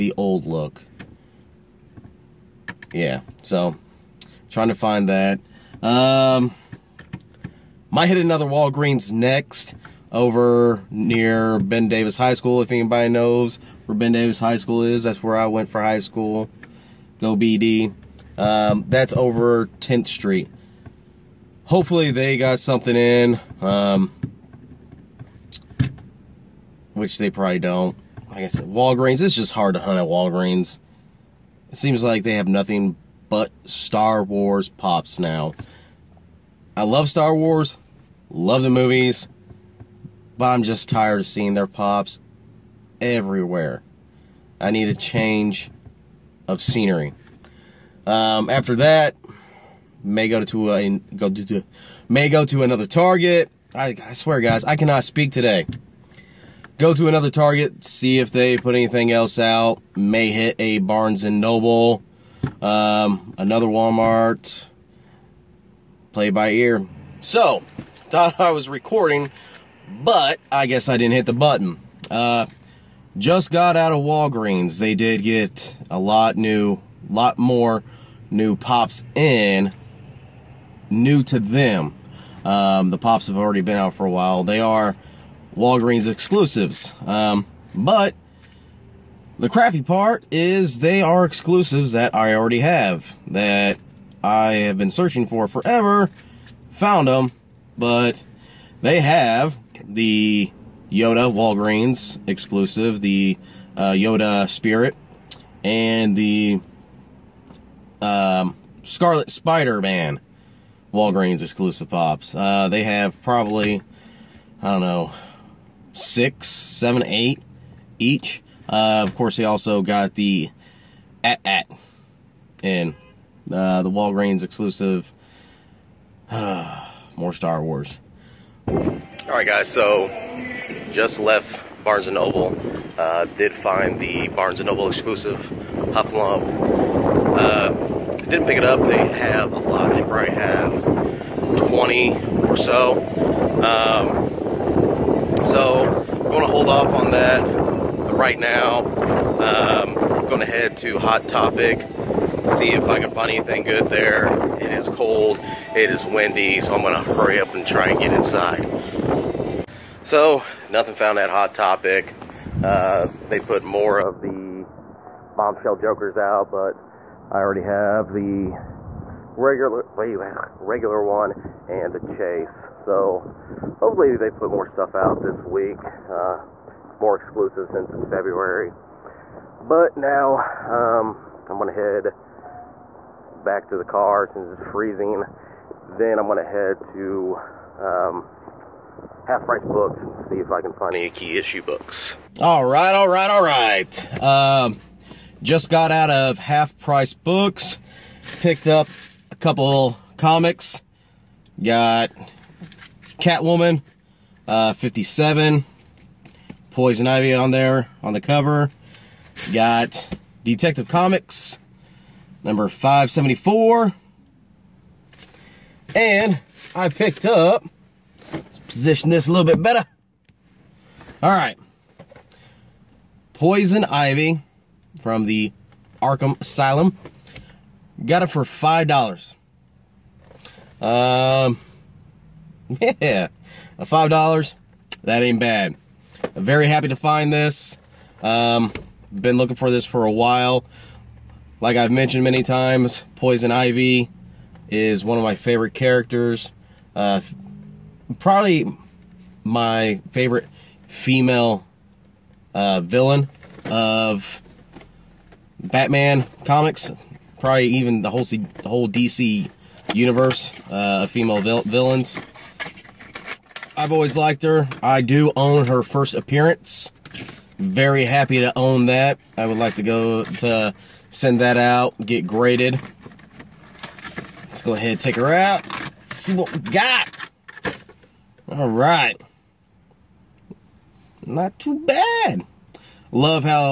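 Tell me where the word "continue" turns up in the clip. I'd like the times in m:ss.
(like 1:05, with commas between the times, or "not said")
not said.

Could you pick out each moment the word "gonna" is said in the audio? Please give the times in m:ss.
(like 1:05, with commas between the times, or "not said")
3:01, 3:06.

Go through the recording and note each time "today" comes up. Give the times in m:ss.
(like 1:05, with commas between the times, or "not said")
0:55.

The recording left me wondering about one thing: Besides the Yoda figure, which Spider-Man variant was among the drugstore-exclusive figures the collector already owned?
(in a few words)
Scarlet Spider-Man.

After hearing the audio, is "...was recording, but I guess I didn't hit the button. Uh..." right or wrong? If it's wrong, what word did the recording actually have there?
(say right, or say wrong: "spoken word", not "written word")
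right.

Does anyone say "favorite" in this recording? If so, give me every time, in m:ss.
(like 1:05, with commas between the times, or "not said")
4:05, 4:10.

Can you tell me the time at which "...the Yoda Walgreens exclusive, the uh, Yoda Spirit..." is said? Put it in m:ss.
1:39.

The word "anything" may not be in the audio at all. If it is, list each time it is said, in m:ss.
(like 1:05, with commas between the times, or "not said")
0:58, 2:33.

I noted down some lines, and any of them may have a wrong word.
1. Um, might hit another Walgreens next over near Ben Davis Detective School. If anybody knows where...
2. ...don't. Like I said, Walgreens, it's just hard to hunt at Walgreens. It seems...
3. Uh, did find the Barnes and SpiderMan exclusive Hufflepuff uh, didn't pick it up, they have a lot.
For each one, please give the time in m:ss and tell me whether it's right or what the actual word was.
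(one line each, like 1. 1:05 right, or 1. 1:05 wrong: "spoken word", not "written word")
1. 0:05 wrong: "High", not "Detective"
2. 0:27 right
3. 2:12 wrong: "Noble", not "SpiderMan".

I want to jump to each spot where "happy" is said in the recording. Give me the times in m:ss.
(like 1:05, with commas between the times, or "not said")
3:56, 4:28.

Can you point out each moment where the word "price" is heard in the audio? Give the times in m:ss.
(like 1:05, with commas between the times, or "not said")
3:09, 3:16.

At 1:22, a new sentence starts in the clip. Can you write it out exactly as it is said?
Um, the pops have already been out for a while.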